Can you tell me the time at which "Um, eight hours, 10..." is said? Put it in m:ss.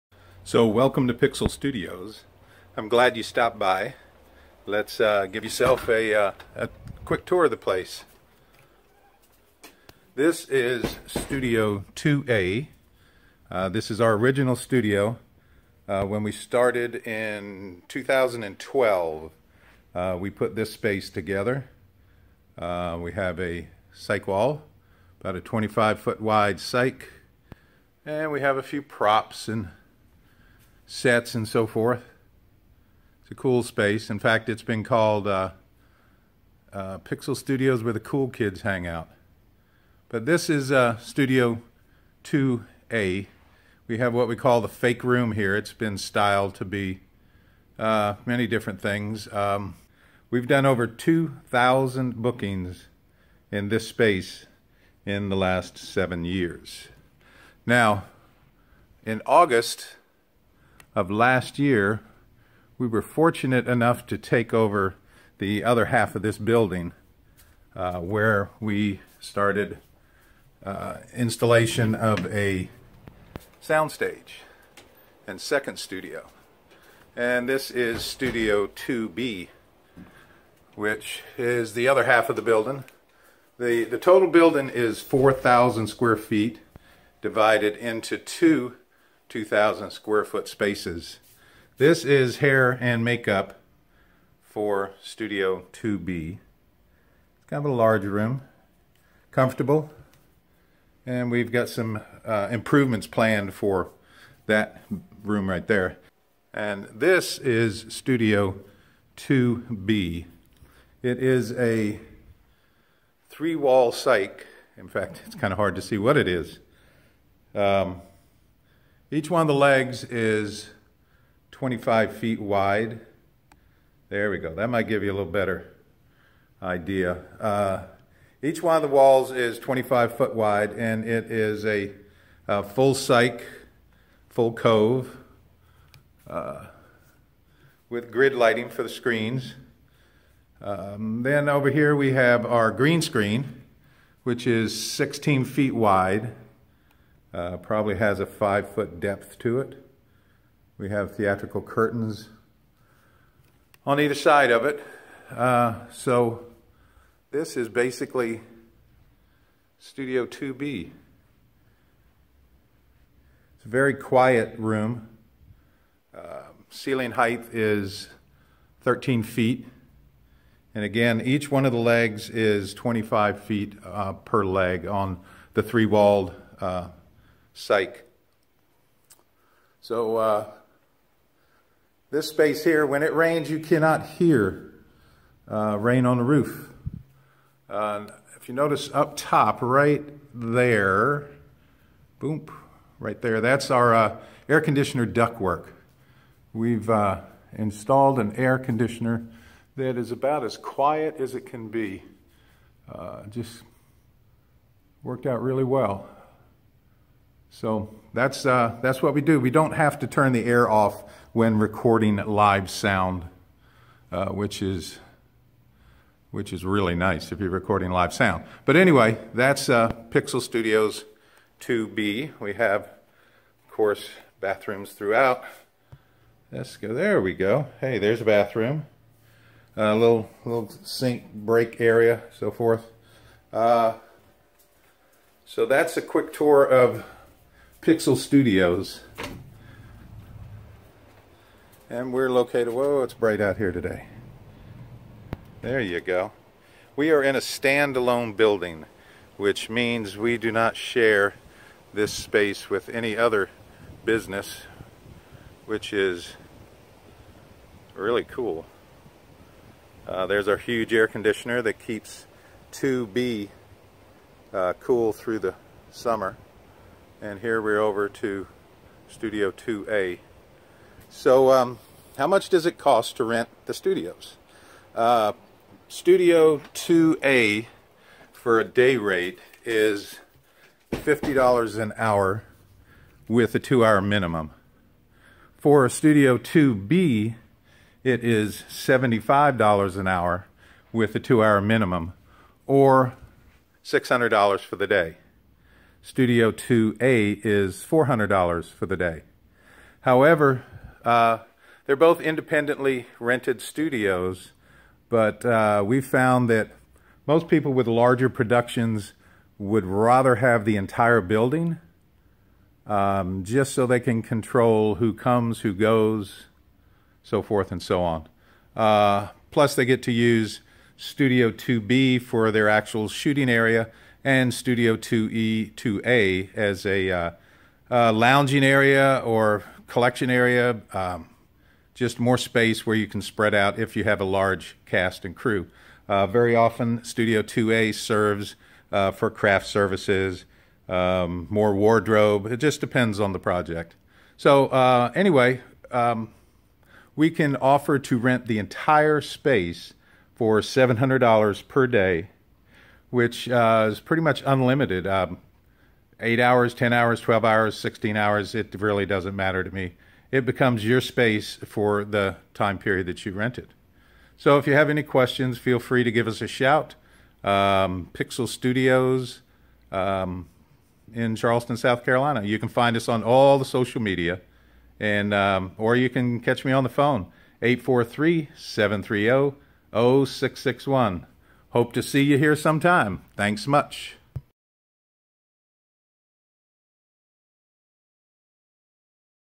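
5:55.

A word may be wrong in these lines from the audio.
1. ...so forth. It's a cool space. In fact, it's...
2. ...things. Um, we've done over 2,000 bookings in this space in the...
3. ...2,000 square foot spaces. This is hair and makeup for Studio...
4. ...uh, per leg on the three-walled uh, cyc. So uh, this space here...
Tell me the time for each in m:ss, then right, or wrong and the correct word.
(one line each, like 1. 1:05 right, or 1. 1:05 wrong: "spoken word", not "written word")
1. 0:31 right
2. 0:48 right
3. 1:29 right
4. 2:53 right.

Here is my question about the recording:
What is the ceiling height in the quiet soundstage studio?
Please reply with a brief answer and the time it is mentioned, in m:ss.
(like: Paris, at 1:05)
13 feet, at 2:48.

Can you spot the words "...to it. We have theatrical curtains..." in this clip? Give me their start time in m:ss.
2:29.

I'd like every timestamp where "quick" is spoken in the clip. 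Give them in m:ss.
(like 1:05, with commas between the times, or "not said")
0:07, 3:56.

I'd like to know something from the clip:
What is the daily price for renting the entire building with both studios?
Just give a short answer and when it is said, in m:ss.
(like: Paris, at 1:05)
$700, at 5:50.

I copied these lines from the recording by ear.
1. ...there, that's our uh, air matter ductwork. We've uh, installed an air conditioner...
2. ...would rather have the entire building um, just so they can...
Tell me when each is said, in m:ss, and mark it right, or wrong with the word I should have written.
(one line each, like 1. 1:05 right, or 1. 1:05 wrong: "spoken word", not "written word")
1. 3:13 wrong: "conditioner", not "matter"
2. 5:09 right.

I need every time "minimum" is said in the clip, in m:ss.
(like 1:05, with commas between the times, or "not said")
4:44, 4:51.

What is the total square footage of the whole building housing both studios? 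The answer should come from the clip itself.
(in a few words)
4,000 square feet.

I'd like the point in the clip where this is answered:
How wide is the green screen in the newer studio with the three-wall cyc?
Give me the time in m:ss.
2:24.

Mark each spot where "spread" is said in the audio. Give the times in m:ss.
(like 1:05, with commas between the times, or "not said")
5:33.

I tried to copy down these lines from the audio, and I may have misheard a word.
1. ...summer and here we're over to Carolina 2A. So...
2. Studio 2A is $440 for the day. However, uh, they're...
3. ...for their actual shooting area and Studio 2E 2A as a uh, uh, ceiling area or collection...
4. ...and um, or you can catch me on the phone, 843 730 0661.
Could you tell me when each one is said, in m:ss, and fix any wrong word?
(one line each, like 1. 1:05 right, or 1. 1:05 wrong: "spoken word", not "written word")
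1. 4:25 wrong: "Studio", not "Carolina"
2. 4:56 wrong: "400", not "440"
3. 5:22 wrong: "lounging", not "ceiling"
4. 6:15 right.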